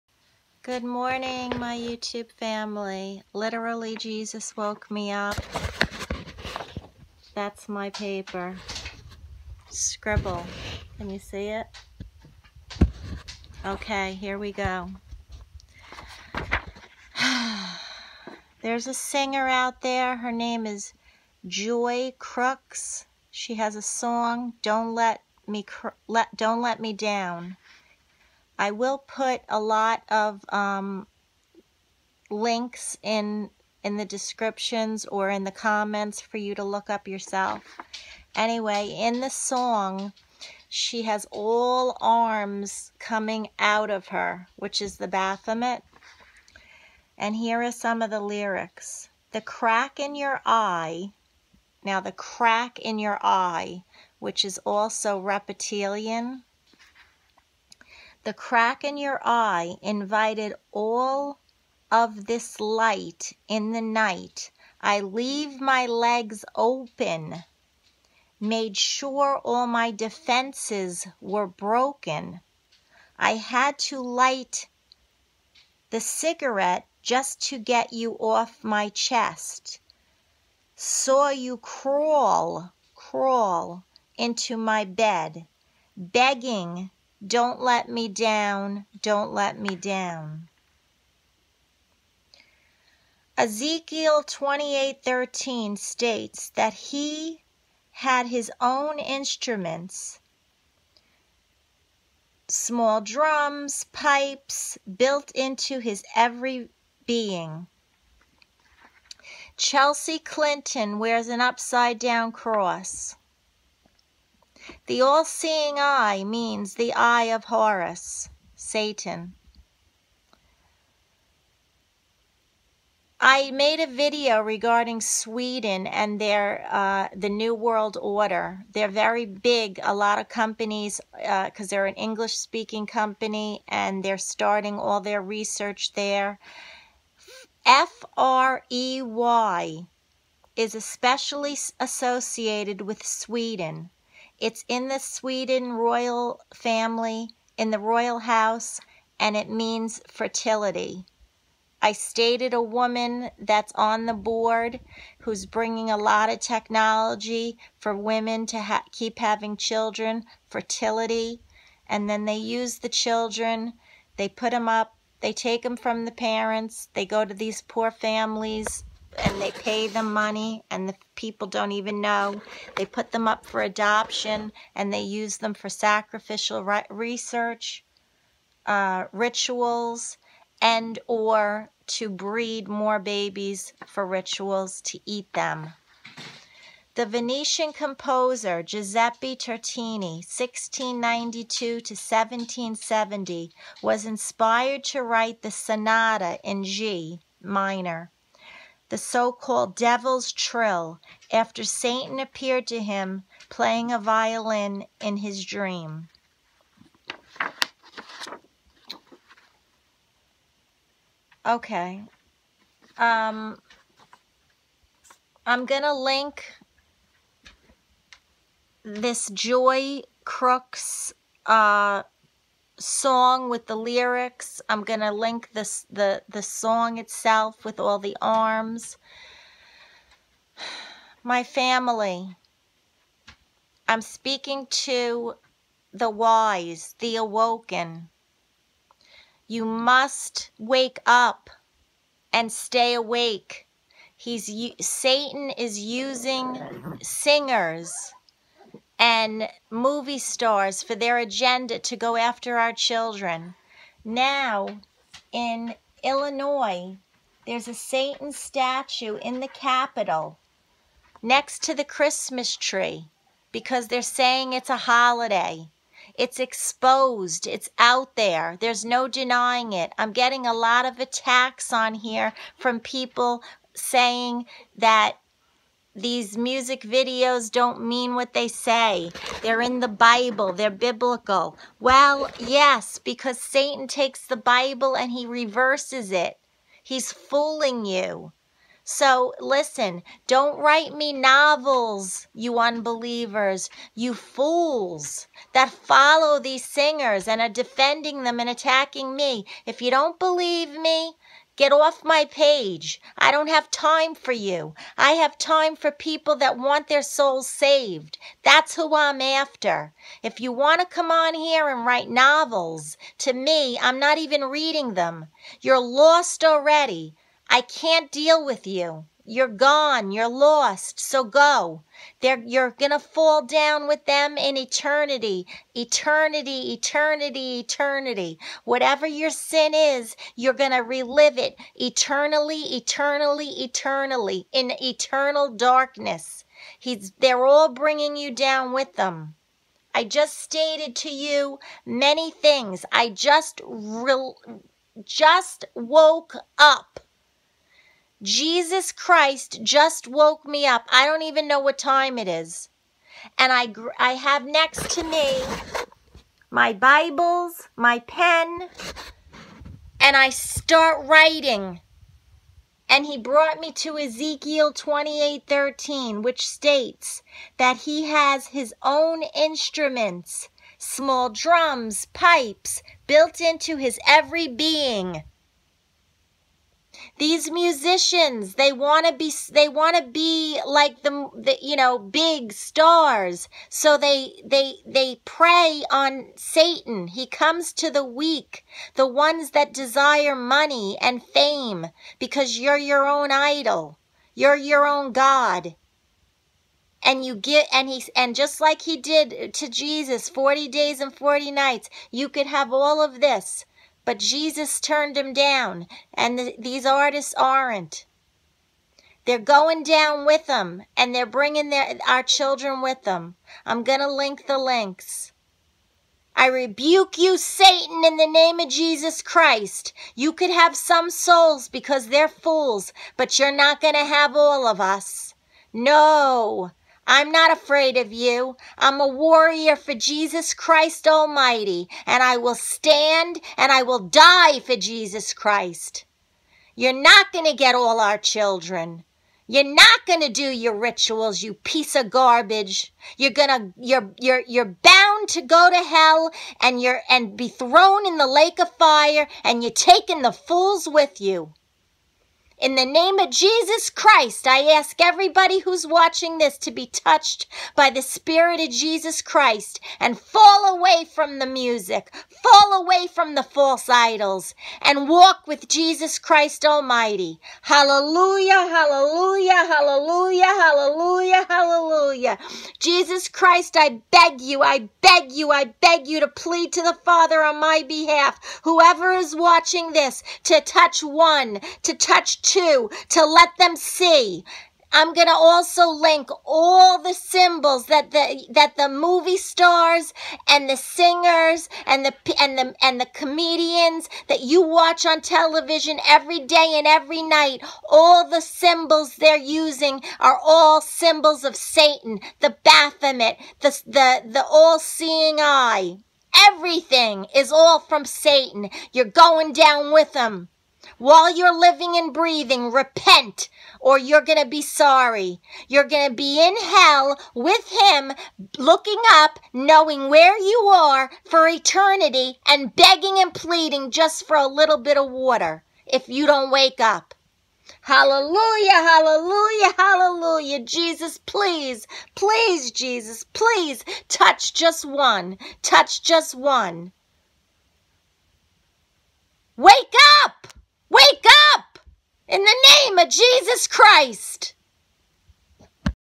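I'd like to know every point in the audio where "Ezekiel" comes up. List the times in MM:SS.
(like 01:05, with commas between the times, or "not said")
01:33, 06:03.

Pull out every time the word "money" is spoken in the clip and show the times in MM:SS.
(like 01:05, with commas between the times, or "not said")
02:50, 06:30.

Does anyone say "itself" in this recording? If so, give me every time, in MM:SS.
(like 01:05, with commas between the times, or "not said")
03:46.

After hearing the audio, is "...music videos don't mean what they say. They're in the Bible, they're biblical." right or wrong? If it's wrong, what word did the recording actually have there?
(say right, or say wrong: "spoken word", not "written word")
right.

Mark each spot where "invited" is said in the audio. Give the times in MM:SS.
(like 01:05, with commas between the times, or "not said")
00:59.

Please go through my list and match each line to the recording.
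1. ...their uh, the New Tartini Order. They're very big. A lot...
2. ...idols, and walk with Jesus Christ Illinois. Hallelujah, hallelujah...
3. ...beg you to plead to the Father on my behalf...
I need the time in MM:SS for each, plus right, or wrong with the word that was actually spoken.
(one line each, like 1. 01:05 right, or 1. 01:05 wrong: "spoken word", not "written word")
1. 02:06 wrong: "World", not "Tartini"
2. 07:43 wrong: "Almighty", not "Illinois"
3. 07:55 right.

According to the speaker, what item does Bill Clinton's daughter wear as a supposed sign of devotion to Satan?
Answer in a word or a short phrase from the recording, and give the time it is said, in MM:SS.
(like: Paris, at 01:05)
upside down cross, at 01:51.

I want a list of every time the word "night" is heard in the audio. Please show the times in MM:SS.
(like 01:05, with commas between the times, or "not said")
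01:03, 06:41, 08:17.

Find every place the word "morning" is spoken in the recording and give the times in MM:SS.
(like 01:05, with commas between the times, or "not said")
00:00.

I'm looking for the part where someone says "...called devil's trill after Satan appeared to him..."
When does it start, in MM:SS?
03:19.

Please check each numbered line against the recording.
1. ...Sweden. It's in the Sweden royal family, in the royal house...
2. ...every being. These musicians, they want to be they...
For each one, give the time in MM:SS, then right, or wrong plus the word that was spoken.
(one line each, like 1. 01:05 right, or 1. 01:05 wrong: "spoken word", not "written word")
1. 02:23 right
2. 06:14 right.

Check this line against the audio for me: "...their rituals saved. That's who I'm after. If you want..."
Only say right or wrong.
wrong.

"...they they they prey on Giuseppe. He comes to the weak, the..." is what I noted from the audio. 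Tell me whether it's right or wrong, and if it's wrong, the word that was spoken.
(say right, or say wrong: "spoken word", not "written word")
wrong: "Satan", not "Giuseppe".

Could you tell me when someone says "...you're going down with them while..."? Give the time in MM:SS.
08:28.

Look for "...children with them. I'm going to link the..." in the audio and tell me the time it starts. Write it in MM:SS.
06:52.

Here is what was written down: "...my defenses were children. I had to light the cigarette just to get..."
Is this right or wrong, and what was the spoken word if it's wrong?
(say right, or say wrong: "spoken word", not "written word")
wrong: "broken", not "children".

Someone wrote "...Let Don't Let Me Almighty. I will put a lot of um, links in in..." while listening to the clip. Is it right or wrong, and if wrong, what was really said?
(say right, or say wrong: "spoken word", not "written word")
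wrong: "Down", not "Almighty".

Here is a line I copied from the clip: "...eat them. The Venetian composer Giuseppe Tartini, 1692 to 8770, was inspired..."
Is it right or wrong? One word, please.
wrong.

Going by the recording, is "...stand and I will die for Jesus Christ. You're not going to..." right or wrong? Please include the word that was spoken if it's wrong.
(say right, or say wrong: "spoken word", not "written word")
right.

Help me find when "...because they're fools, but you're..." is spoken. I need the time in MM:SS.
07:01.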